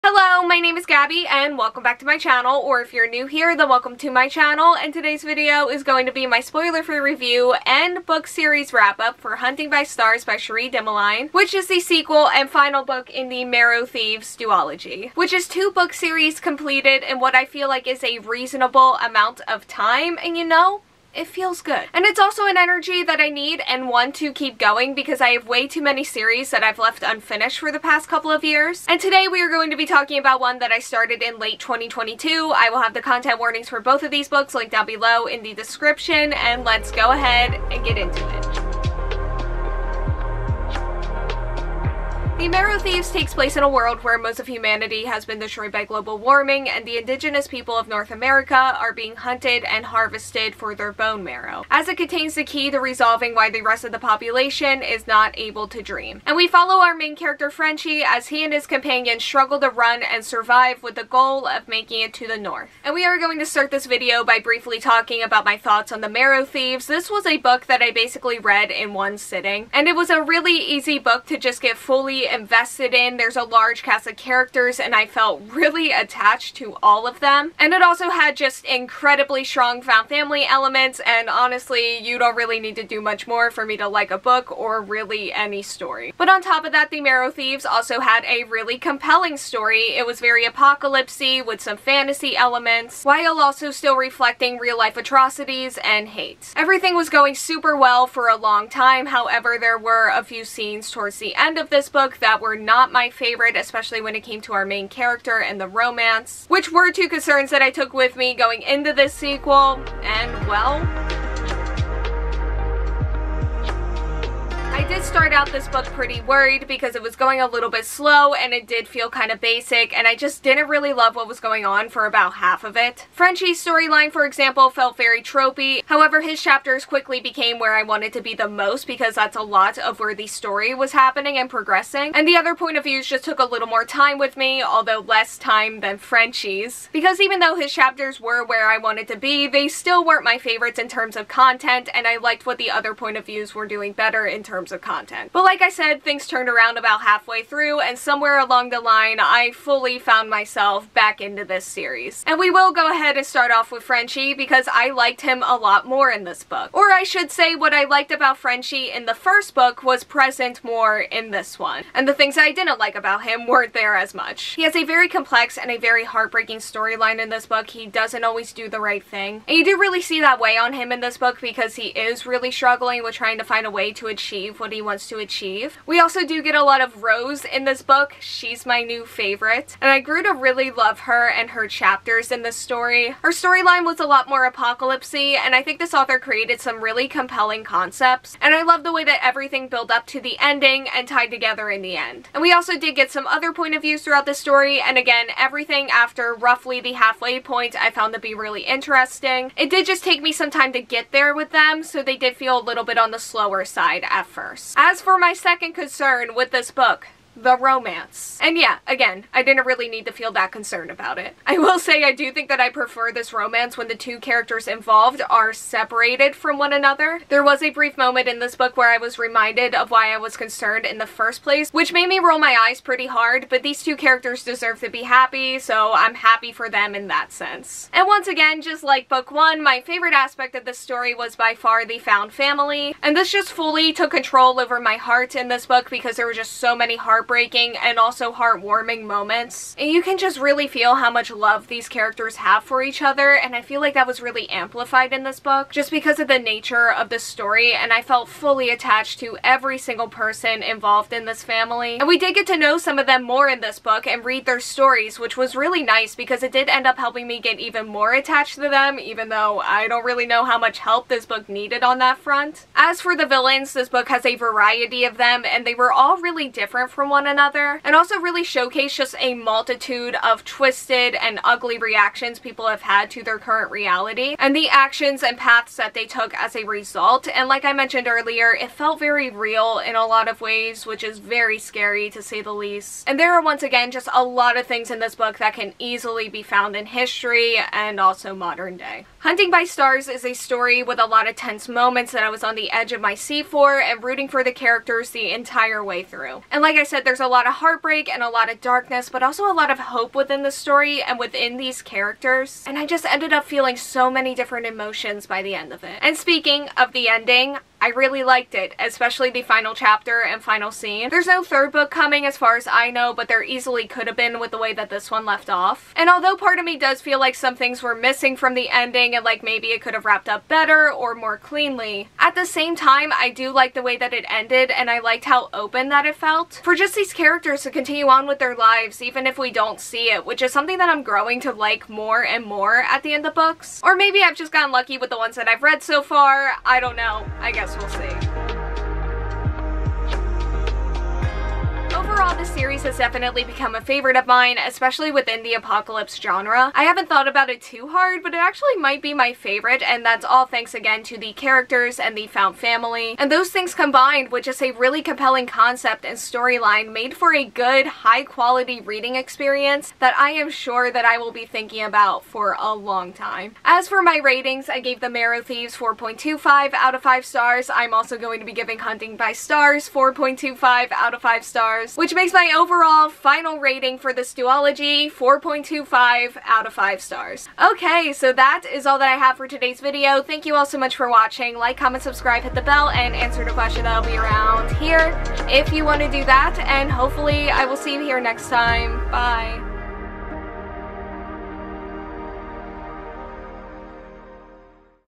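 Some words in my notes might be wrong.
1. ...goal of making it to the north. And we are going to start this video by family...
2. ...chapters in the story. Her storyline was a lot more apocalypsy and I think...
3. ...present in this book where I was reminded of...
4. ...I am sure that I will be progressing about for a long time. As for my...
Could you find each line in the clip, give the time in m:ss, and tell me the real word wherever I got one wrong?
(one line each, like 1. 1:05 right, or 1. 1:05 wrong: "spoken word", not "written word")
1. 1:01 wrong: "briefly", not "family"
2. 3:01 right
3. 3:37 wrong: "moment", not "present"
4. 6:00 wrong: "thinking", not "progressing".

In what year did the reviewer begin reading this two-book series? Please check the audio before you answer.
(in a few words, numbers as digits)
2022.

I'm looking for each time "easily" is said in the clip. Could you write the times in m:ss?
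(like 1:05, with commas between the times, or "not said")
4:45, 5:13.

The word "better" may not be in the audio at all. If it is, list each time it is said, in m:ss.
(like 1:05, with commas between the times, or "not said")
2:23, 5:20.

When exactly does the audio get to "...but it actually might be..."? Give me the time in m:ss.
5:48.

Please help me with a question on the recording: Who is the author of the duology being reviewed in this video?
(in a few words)
Cherie Dimaline.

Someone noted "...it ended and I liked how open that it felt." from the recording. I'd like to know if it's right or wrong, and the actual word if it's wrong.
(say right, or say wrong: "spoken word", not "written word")
right.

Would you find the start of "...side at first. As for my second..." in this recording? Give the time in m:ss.
3:23.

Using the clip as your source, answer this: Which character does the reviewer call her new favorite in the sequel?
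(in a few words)
Rose.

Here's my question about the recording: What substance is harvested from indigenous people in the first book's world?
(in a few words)
Bone marrow.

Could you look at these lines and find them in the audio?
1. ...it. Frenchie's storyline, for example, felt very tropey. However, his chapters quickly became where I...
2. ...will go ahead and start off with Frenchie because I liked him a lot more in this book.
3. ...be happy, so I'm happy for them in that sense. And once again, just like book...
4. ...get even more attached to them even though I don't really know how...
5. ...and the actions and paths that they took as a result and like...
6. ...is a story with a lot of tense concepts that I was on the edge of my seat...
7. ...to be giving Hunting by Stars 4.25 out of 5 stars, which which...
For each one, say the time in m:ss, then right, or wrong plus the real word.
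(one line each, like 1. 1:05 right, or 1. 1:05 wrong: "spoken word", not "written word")
1. 2:02 right
2. 2:32 right
3. 3:44 right
4. 4:17 right
5. 4:34 right
6. 4:50 wrong: "moments", not "concepts"
7. 6:08 right.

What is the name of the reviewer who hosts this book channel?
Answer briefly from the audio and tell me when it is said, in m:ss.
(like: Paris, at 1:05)
Gabby, at 0:00.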